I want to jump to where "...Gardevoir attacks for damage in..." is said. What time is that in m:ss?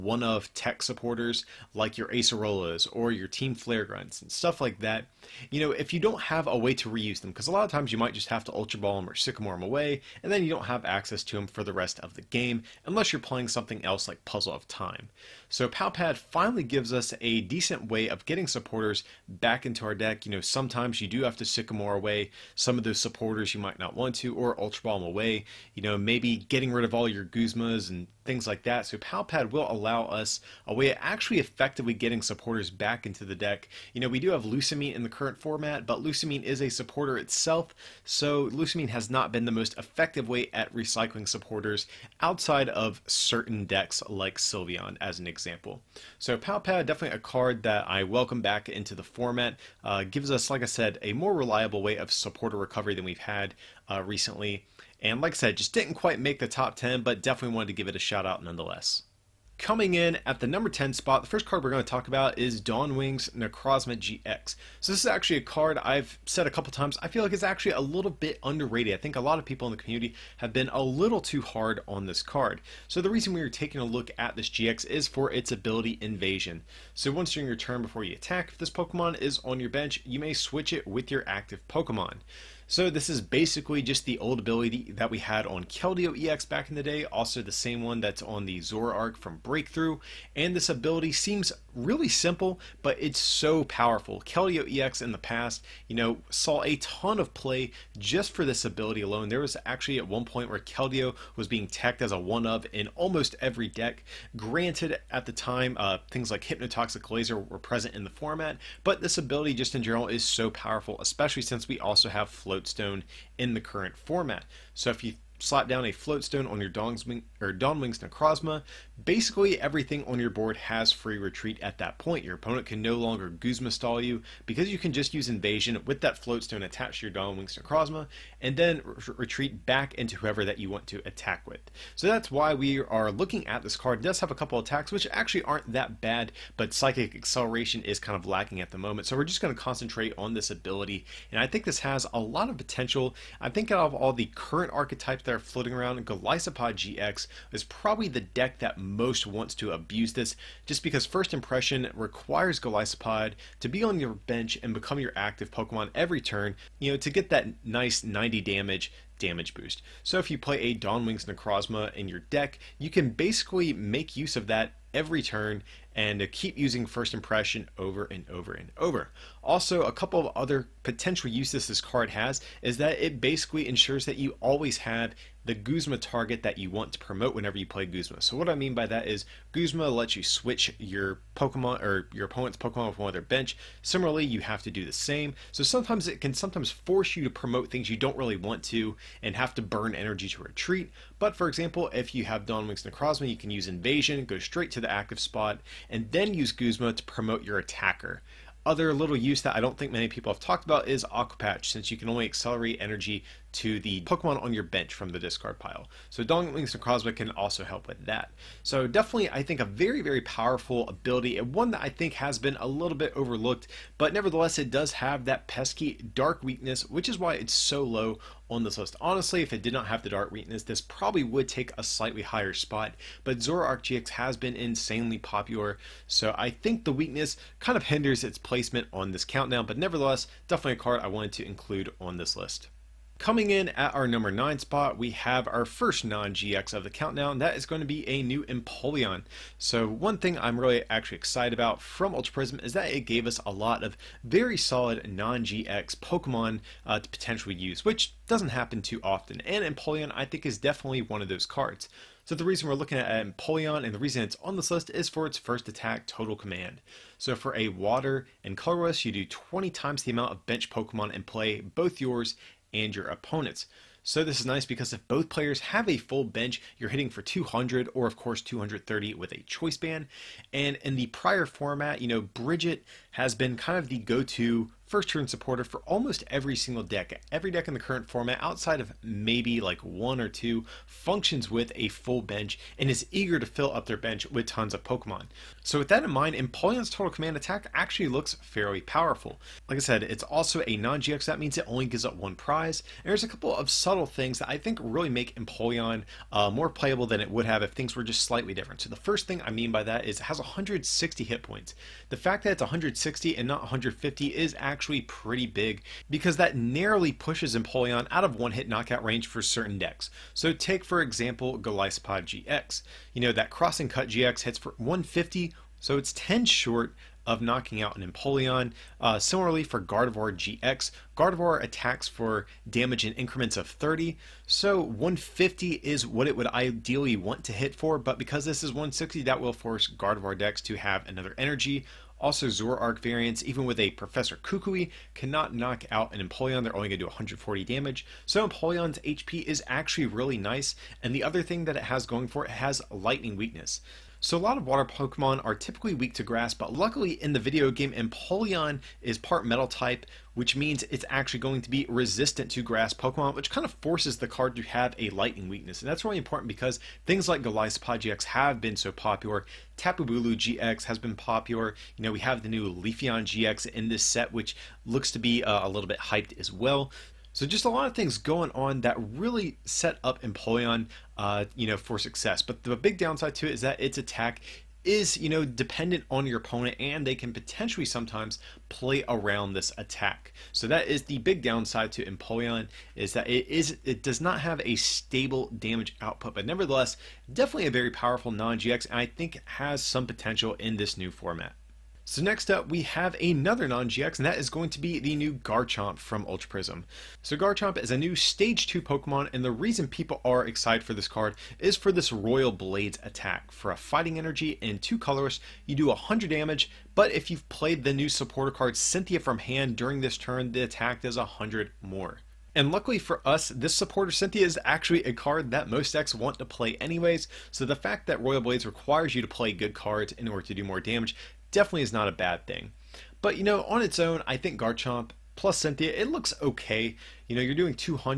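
5:21.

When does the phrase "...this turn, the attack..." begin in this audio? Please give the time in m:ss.
6:49.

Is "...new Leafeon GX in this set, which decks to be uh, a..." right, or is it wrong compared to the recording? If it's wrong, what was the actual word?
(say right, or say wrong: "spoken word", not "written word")
wrong: "looks", not "decks".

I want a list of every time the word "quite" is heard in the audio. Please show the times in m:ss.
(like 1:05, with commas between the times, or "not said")
0:55.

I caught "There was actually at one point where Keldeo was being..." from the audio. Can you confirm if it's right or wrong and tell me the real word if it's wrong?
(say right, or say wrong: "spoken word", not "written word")
right.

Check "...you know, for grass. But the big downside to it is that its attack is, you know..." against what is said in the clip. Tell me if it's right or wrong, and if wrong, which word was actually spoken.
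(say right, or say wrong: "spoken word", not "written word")
wrong: "success", not "grass".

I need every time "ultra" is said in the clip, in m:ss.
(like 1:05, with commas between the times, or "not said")
0:08, 0:24, 4:02, 6:36.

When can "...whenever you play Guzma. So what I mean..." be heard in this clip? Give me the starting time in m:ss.
2:57.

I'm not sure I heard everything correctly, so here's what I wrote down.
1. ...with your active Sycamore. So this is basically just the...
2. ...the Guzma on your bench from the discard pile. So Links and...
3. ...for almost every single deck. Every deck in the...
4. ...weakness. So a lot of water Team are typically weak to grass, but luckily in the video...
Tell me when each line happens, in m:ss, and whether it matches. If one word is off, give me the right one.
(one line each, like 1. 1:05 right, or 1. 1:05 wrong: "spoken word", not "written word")
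1. 1:20 wrong: "Pokemon", not "Sycamore"
2. 3:23 wrong: "Pokemon", not "Guzma"
3. 4:35 right
4. 5:43 wrong: "Pokemon", not "Team".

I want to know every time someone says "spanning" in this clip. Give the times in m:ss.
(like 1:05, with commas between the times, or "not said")
not said.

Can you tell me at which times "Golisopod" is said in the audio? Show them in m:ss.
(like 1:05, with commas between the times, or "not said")
2:26, 2:32, 5:11, 5:57.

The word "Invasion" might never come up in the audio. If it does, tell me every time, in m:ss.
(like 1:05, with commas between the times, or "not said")
1:15, 2:05, 3:13.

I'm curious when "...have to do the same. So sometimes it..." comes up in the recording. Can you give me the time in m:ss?
3:04.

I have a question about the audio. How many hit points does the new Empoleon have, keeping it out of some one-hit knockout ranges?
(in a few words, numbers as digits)
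160.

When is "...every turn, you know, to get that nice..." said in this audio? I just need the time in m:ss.
2:35.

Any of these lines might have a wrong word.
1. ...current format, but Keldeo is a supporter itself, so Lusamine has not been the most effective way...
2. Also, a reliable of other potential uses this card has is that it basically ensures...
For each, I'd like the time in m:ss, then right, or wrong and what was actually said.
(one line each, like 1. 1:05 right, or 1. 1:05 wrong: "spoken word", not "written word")
1. 0:35 wrong: "Lusamine", not "Keldeo"
2. 2:49 wrong: "couple", not "reliable".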